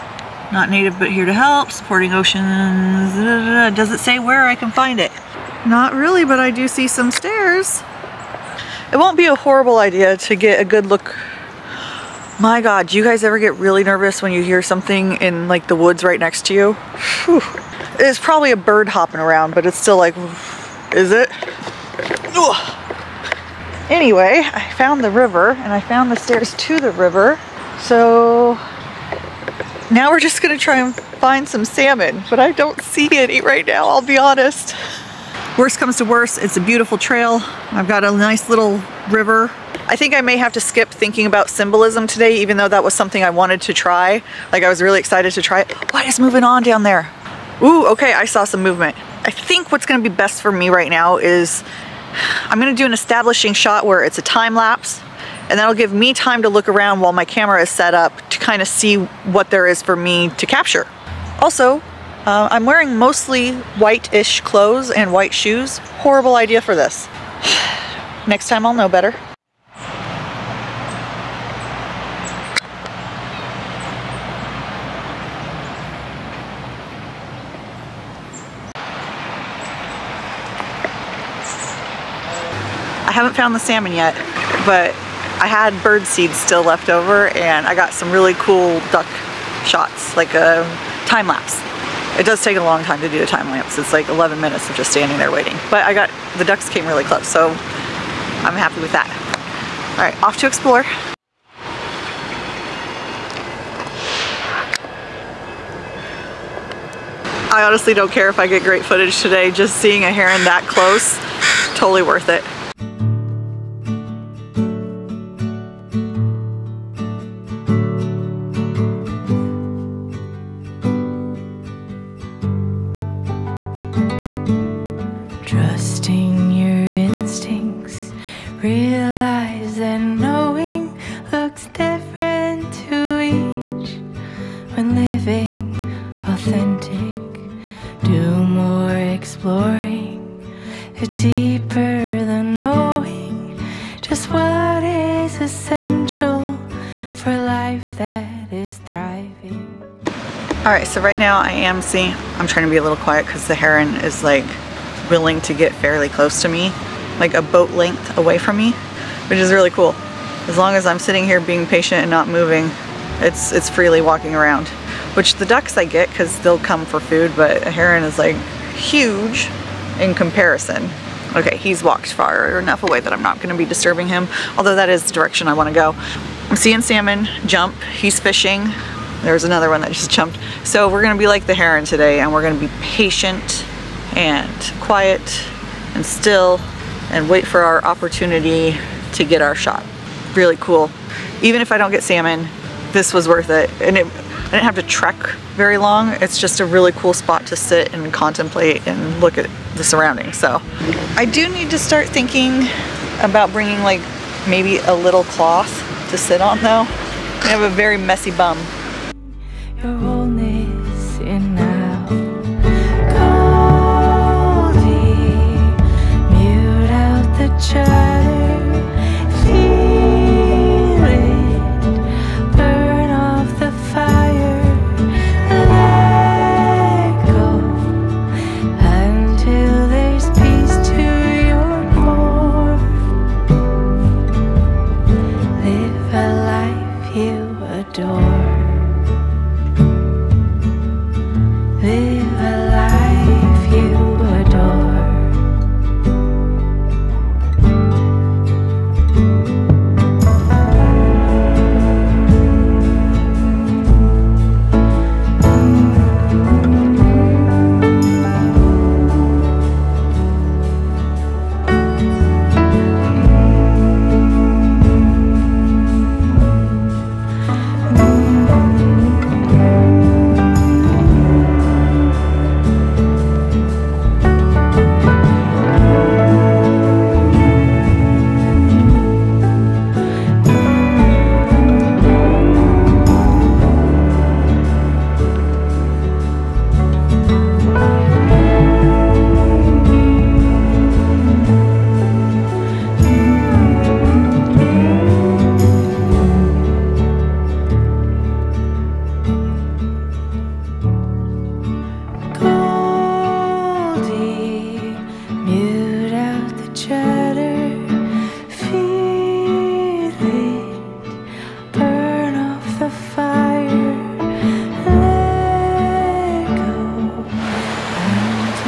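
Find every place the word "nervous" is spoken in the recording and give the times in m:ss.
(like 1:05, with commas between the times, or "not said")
0:13.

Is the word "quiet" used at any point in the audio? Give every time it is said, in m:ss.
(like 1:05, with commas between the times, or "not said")
2:32, 3:04.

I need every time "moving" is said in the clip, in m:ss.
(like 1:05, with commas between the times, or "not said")
0:46, 2:42.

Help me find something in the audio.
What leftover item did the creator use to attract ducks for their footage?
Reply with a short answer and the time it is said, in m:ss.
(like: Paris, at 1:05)
bird seeds, at 1:25.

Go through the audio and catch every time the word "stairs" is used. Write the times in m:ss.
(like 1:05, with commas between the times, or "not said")
0:07, 0:26.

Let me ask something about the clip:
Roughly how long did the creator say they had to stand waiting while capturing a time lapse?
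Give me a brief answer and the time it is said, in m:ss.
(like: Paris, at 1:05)
11 minutes, at 1:34.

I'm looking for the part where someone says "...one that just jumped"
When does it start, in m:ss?
2:59.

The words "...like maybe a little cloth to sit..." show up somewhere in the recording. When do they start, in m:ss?
3:23.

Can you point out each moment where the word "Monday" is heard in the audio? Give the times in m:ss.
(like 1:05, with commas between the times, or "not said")
not said.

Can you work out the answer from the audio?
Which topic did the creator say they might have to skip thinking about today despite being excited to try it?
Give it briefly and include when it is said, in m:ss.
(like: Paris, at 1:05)
symbolism, at 0:41.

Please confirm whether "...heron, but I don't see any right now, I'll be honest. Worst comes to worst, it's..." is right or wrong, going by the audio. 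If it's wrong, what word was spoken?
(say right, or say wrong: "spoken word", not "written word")
wrong: "salmon", not "heron".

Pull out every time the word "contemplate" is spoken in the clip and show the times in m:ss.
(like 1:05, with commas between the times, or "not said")
3:18.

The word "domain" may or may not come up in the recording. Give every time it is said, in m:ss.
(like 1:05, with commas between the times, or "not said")
not said.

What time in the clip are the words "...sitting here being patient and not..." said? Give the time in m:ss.
2:40.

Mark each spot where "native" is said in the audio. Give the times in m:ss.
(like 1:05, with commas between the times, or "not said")
0:00.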